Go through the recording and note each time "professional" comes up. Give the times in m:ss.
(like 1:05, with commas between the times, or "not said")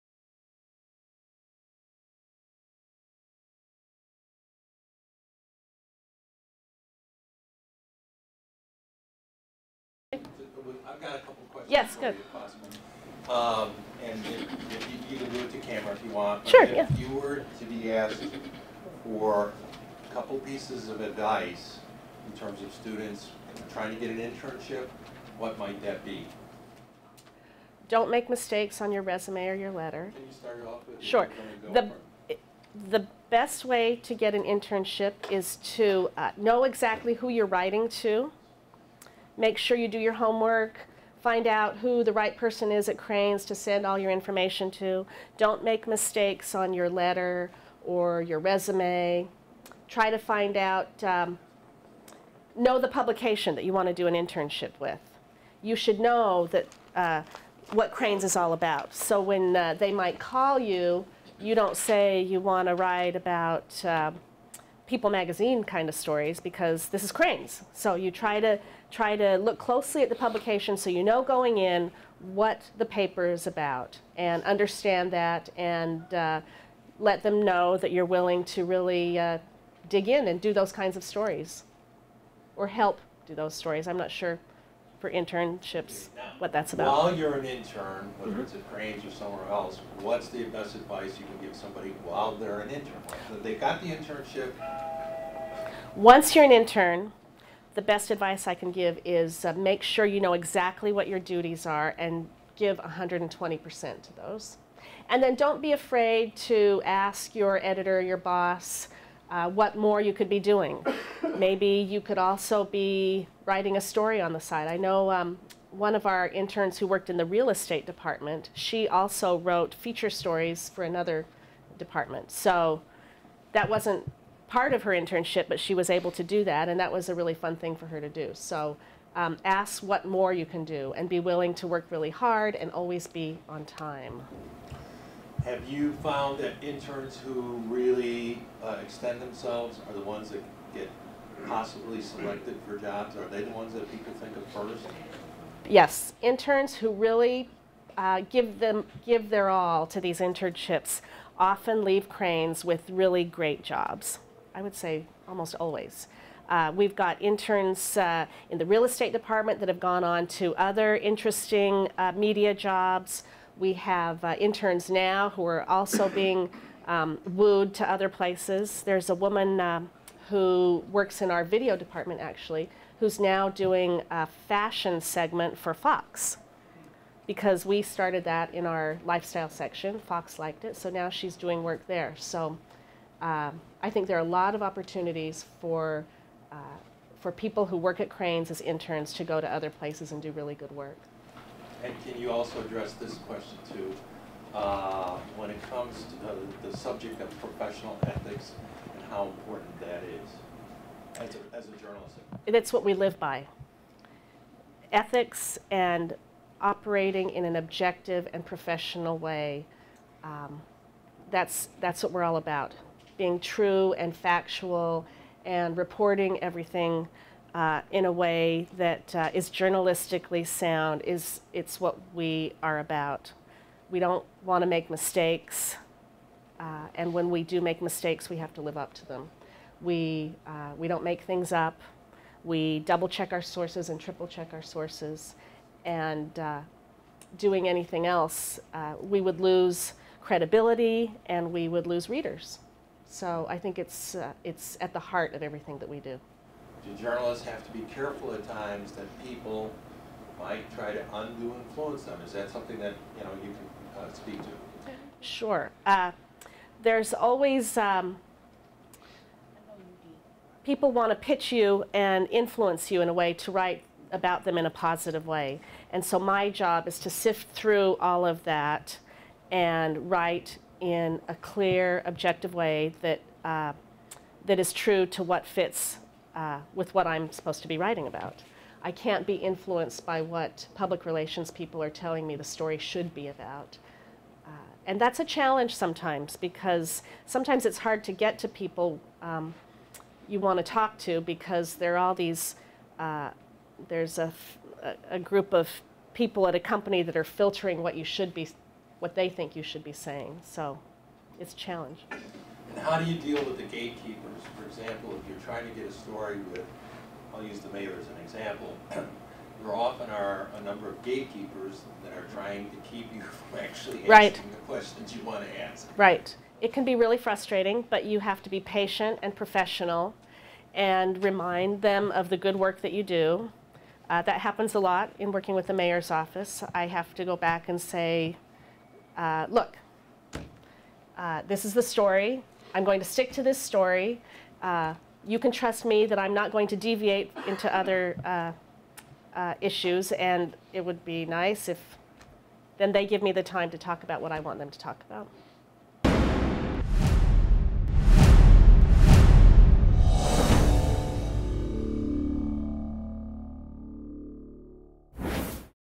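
3:17, 3:28, 5:19.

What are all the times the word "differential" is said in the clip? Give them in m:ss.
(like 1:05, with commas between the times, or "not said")
not said.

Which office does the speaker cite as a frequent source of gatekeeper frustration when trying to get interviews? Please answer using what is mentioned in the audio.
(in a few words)
the mayor's office.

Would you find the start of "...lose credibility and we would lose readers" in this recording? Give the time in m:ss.
3:59.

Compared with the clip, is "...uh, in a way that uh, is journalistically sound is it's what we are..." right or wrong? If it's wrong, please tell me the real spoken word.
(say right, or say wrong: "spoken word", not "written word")
right.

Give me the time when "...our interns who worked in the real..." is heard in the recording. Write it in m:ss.
1:56.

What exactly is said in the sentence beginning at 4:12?
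Is that something that you know you can uh, speak to?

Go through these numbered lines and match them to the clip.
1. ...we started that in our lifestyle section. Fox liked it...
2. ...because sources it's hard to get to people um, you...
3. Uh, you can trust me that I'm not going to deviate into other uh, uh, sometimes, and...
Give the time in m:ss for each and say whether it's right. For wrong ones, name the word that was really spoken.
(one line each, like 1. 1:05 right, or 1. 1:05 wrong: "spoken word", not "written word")
1. 2:57 right
2. 4:46 wrong: "sometimes", not "sources"
3. 5:34 wrong: "issues", not "sometimes".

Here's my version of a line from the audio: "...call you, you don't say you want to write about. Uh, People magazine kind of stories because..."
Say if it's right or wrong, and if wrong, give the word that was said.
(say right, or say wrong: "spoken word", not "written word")
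right.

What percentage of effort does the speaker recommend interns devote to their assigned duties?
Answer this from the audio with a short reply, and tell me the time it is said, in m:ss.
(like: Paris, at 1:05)
120%, at 1:42.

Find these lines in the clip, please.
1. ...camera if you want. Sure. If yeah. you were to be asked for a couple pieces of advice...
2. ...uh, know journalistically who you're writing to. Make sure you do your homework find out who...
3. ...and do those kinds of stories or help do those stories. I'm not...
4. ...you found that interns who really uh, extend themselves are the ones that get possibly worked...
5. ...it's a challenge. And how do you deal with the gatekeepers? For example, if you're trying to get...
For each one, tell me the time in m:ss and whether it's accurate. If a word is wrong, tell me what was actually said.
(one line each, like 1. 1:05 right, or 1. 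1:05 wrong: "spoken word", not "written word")
1. 0:15 right
2. 0:36 wrong: "exactly", not "journalistically"
3. 1:20 right
4. 2:15 wrong: "selected", not "worked"
5. 5:01 right.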